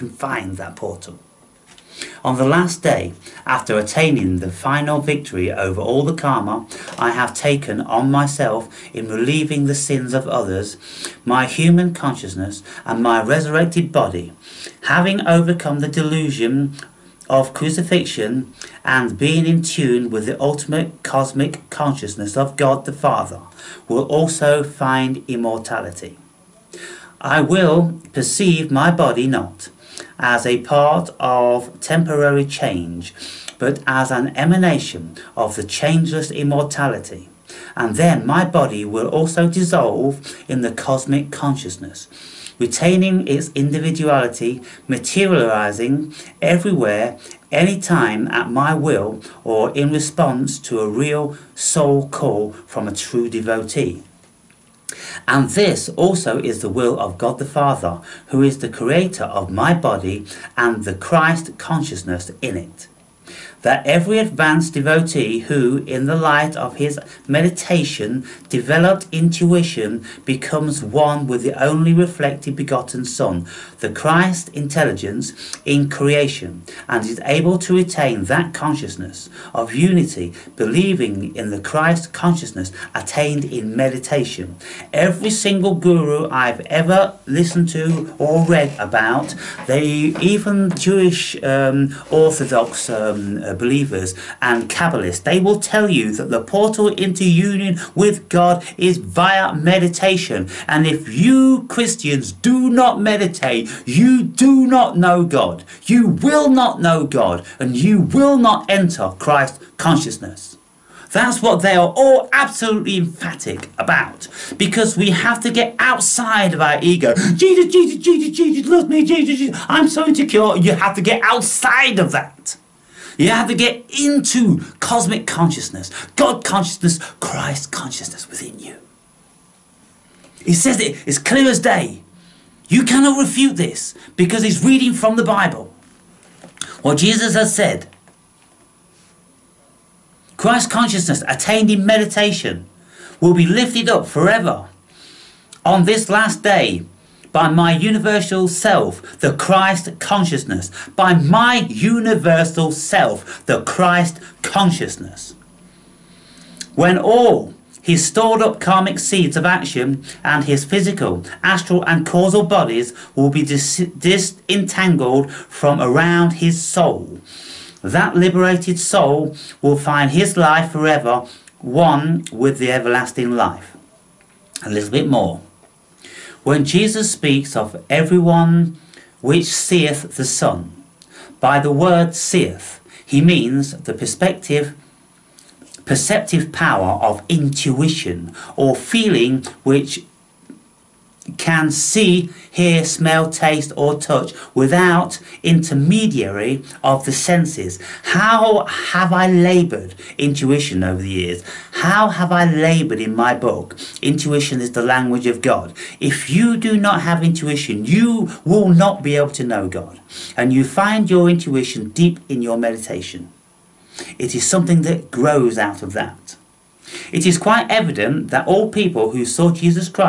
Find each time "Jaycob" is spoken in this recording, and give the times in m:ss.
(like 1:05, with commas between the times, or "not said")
not said.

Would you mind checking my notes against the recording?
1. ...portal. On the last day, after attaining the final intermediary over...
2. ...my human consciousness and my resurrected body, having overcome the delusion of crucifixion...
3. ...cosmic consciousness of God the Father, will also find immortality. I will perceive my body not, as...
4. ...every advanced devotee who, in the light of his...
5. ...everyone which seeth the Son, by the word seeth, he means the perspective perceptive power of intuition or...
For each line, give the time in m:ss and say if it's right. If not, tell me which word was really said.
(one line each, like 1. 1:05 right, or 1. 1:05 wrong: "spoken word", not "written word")
1. 0:00 wrong: "victory", not "intermediary"
2. 0:11 right
3. 0:21 right
4. 1:03 right
5. 2:57 right.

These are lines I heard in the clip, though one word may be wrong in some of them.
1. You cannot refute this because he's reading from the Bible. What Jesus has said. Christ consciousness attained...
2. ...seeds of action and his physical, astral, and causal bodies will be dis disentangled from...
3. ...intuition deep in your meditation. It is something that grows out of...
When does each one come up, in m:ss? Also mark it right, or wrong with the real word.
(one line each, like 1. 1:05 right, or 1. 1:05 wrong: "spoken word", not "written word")
1. 2:12 right
2. 2:38 right
3. 3:31 right.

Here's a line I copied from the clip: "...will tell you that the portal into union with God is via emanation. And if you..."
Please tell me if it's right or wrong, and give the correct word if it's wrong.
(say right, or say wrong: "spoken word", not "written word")
wrong: "meditation", not "emanation".